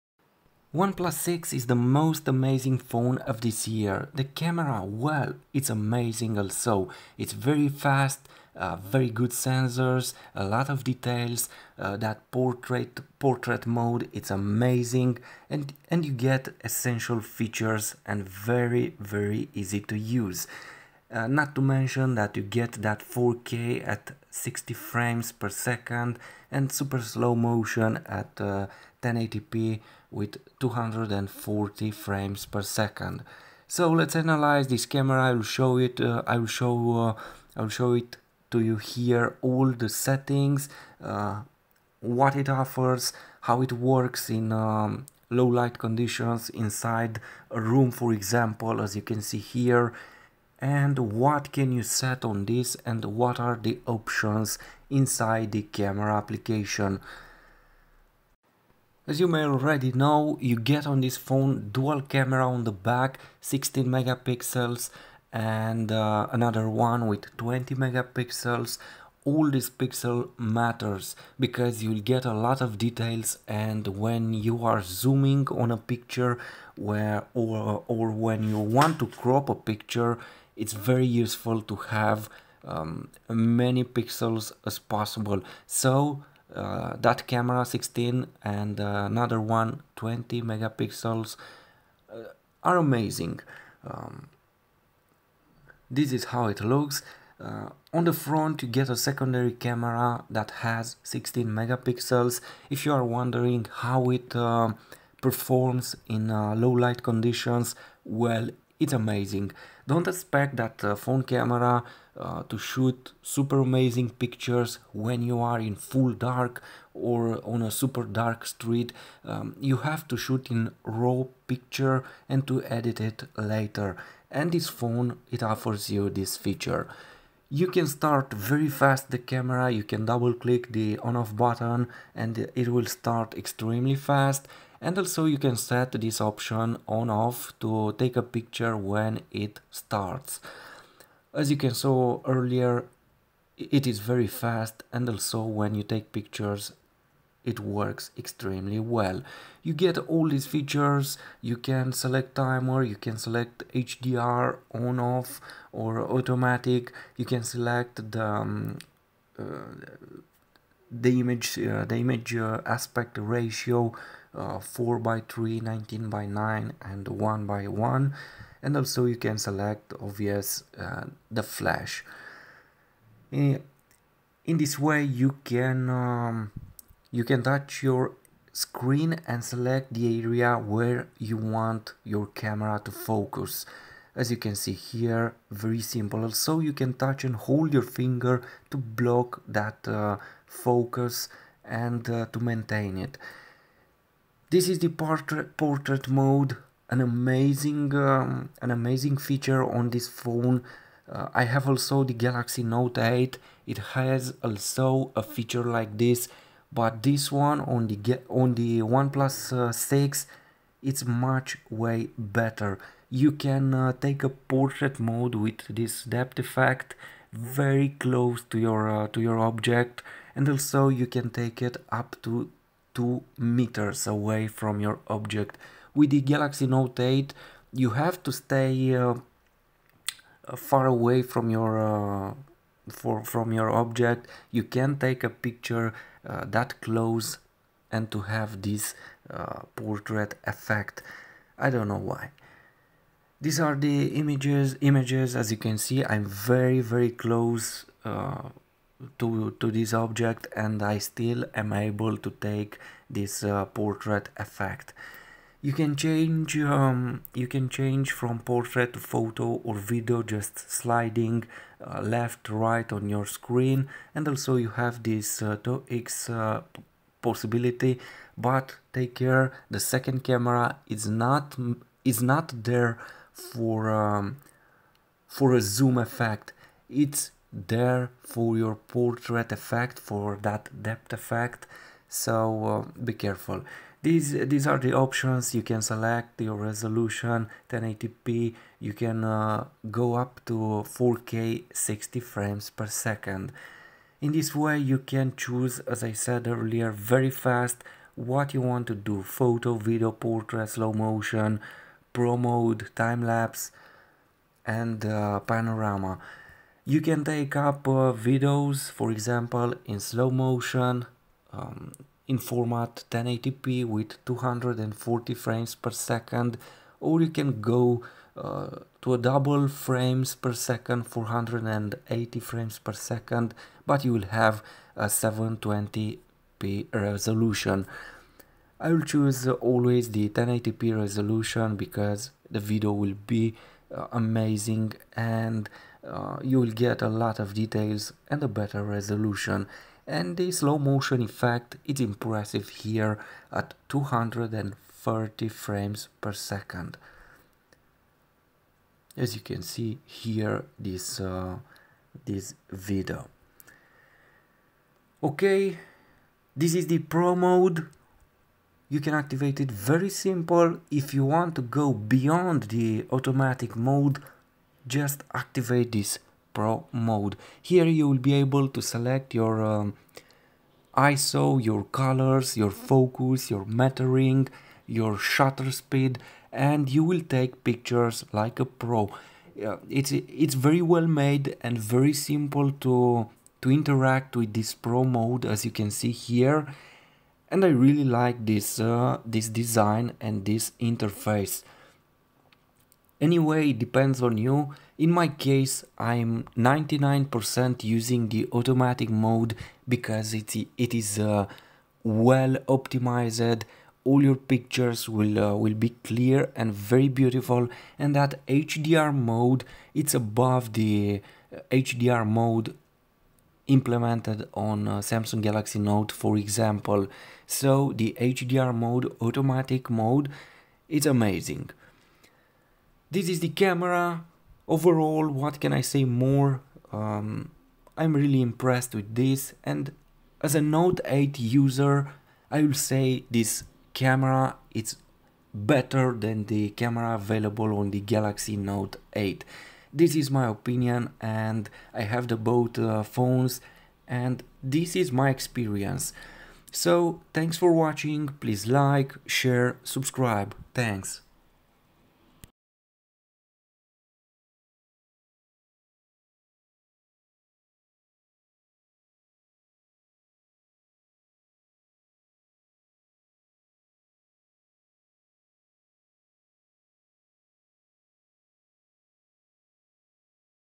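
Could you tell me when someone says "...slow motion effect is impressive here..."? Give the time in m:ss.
5:40.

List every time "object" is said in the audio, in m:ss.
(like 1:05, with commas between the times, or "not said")
3:39, 3:45, 3:53, 4:09.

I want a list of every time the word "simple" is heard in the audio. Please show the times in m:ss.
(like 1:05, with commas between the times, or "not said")
3:05, 6:00, 6:22.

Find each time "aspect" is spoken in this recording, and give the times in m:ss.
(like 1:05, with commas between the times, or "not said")
2:42.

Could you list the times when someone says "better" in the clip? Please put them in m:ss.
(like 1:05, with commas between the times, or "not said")
3:32, 5:38, 7:15.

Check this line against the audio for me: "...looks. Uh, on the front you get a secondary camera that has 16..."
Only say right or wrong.
right.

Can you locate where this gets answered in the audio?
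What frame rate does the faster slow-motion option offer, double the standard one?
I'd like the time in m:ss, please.
5:21.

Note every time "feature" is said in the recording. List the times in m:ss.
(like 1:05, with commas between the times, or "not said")
0:17, 2:06, 2:30, 3:19, 3:25.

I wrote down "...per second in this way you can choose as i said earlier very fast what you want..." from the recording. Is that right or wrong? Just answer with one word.
right.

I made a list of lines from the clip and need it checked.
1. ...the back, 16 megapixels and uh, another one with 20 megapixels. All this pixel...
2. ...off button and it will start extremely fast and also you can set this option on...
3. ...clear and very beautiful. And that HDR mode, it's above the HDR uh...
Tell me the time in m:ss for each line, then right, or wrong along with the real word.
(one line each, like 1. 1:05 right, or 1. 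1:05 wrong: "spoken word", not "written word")
1. 1:02 right
2. 2:11 right
3. 6:46 right.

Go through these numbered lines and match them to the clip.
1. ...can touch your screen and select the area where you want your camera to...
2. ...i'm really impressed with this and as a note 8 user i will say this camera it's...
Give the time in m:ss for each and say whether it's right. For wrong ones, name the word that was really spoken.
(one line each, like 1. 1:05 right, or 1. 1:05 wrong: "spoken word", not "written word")
1. 2:57 right
2. 7:07 right.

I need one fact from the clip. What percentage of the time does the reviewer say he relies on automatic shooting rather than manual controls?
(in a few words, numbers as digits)
99%.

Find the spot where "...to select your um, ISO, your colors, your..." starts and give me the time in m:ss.
6:08.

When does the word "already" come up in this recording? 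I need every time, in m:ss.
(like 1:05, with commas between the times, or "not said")
0:59.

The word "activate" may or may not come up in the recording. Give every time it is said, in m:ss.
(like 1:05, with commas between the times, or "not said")
5:59, 6:05.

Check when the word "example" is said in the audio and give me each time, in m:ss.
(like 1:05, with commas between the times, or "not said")
0:48, 5:09, 6:56.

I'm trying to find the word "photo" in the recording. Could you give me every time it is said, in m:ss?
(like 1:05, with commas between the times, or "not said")
4:18, 4:59.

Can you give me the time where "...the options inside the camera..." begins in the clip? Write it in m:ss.
0:53.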